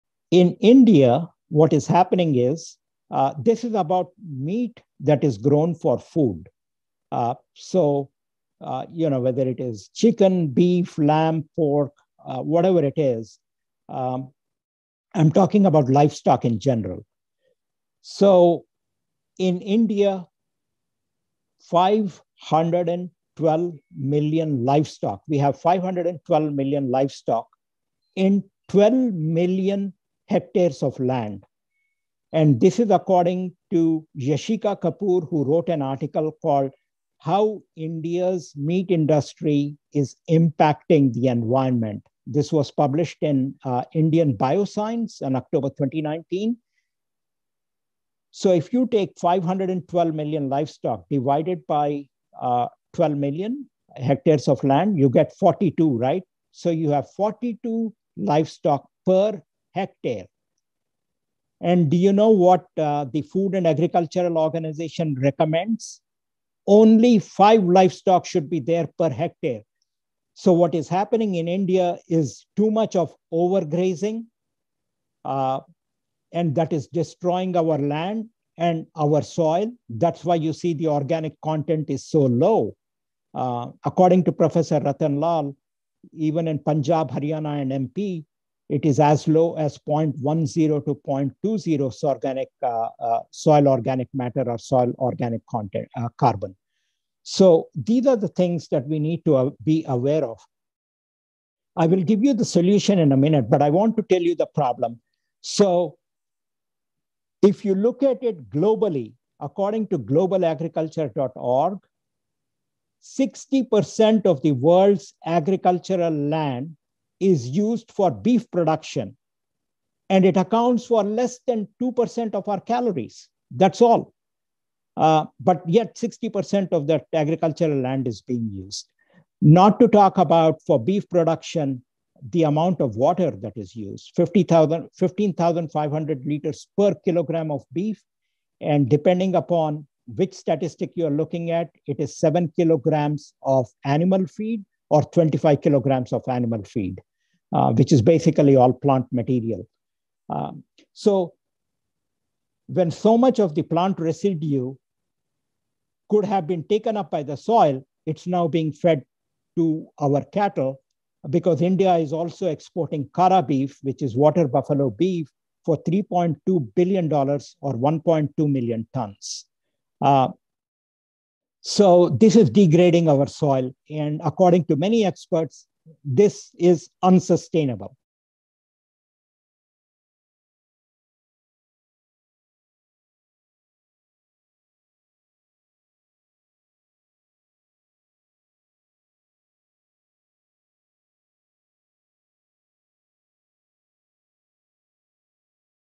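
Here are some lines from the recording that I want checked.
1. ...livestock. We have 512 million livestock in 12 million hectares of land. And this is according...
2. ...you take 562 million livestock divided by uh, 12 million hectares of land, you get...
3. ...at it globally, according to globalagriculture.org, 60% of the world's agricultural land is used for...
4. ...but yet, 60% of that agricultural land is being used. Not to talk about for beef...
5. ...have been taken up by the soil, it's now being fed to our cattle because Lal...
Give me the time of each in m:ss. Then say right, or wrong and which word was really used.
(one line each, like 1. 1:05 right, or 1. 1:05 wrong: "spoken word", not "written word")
1. 0:24 right
2. 0:48 wrong: "512", not "562"
3. 1:48 right
4. 2:05 right
5. 2:36 wrong: "India", not "Lal".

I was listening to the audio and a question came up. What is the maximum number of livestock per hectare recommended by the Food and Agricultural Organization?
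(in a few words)
5.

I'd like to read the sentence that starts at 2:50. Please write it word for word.
Uh, so this is degrading our soil.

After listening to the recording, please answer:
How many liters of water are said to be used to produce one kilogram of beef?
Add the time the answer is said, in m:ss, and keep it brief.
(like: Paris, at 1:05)
15,500 liters, at 2:14.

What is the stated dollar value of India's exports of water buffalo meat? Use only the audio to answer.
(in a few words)
$3.2 billion.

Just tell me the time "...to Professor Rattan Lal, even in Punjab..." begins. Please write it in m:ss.
1:24.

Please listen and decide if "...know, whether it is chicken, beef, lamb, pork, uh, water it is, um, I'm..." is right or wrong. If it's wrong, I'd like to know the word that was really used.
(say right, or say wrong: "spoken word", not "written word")
wrong: "whatever", not "water".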